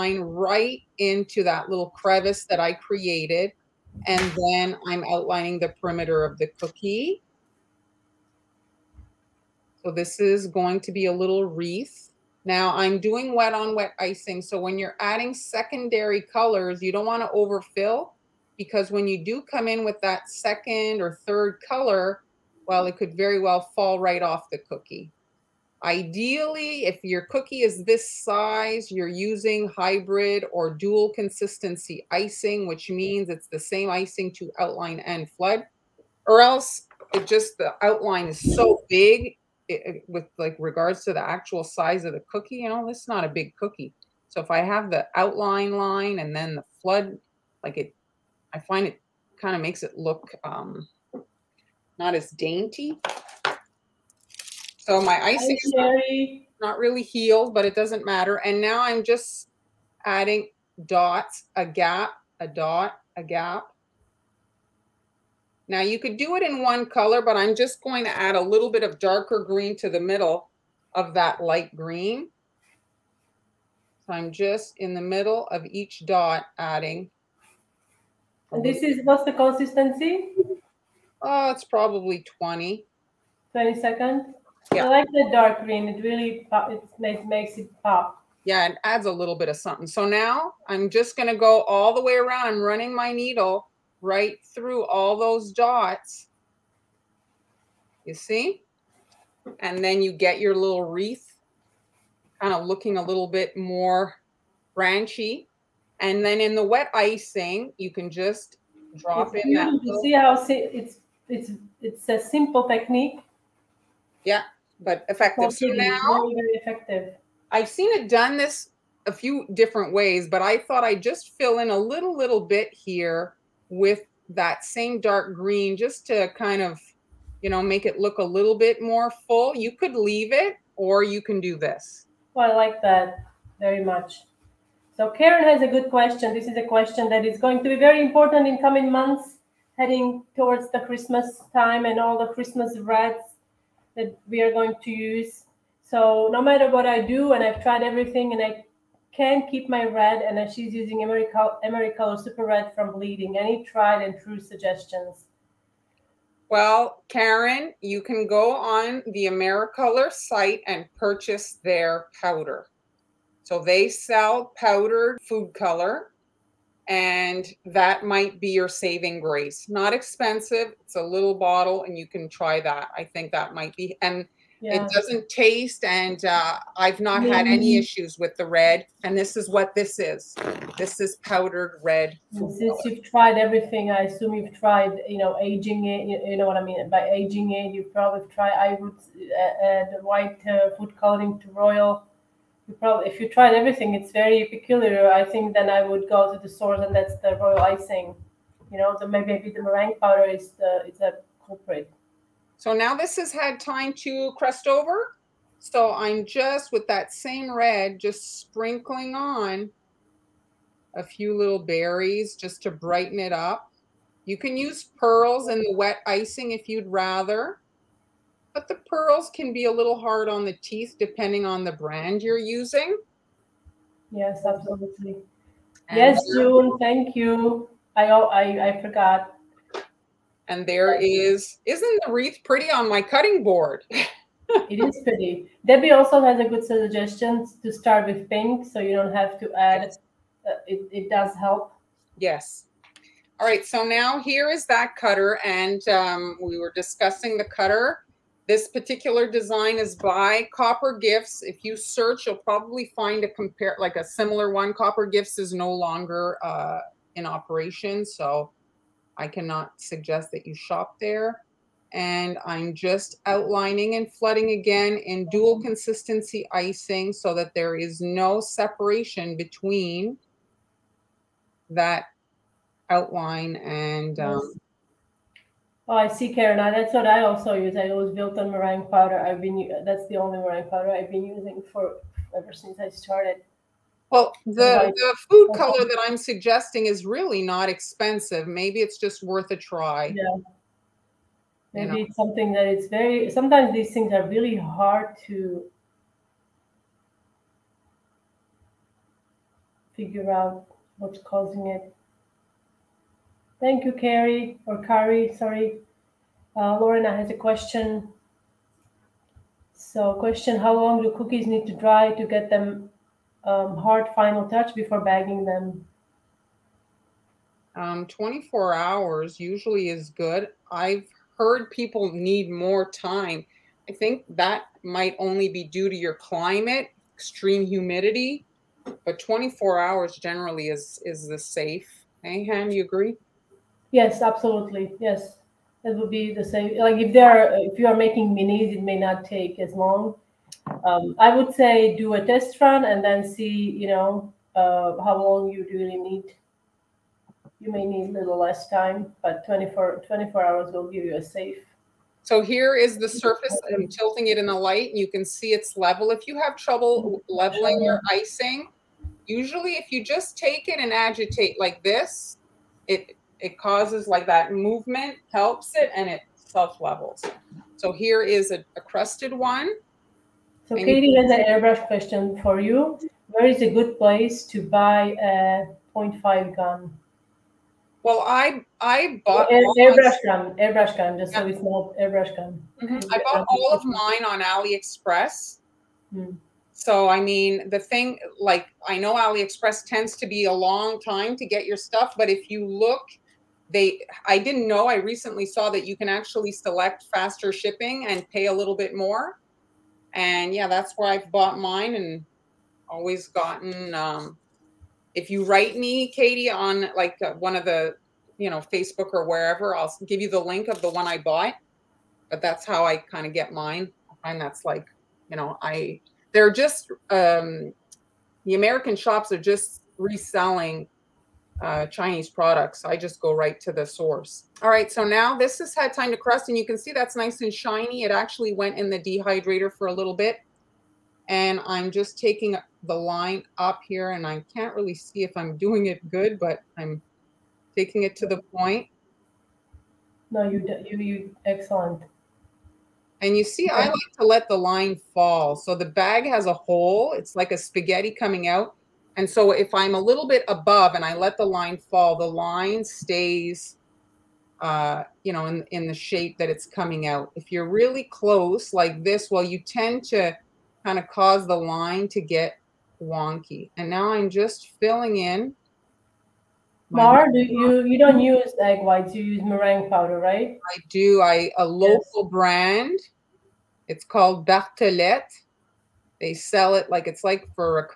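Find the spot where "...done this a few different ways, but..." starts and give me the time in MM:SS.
01:58.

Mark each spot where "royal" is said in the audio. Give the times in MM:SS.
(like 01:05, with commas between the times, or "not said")
03:11, 03:17.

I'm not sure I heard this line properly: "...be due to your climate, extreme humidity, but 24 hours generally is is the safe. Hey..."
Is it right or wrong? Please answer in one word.
right.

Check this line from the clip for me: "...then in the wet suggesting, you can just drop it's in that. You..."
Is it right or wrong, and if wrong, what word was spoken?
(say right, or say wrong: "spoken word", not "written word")
wrong: "icing", not "suggesting".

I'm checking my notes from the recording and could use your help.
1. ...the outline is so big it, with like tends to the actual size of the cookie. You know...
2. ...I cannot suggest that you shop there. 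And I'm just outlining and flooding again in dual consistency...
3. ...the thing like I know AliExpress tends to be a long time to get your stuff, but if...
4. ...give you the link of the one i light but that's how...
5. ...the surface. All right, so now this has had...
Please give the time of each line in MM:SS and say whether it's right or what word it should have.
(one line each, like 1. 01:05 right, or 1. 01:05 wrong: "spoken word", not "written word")
1. 00:37 wrong: "regards", not "tends"
2. 04:19 right
3. 06:27 right
4. 06:50 wrong: "bought", not "light"
5. 07:03 wrong: "source", not "surface".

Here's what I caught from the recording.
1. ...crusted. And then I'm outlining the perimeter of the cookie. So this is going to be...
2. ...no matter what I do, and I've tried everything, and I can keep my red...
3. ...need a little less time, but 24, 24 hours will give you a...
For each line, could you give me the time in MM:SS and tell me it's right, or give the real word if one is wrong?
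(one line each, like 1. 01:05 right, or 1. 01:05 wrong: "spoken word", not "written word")
1. 00:02 wrong: "created", not "crusted"
2. 02:26 right
3. 05:47 right.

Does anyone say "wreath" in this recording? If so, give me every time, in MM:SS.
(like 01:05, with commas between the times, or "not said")
00:11, 01:40, 03:52.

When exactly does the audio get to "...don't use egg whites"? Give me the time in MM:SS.
07:47.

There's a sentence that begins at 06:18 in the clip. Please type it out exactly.
Well, I I bought Air, airbrush gun, airbrush gun, just yeah.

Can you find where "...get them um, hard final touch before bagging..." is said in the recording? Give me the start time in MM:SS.
05:12.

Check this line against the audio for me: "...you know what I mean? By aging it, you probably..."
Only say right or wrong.
right.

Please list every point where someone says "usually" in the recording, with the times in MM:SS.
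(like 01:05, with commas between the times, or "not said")
05:19, 05:59.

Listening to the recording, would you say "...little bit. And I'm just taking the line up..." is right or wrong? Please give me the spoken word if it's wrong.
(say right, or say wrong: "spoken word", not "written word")
right.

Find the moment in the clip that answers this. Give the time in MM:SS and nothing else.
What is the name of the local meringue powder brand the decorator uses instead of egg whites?
07:54.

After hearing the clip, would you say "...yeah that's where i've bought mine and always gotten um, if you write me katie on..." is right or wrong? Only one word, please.
right.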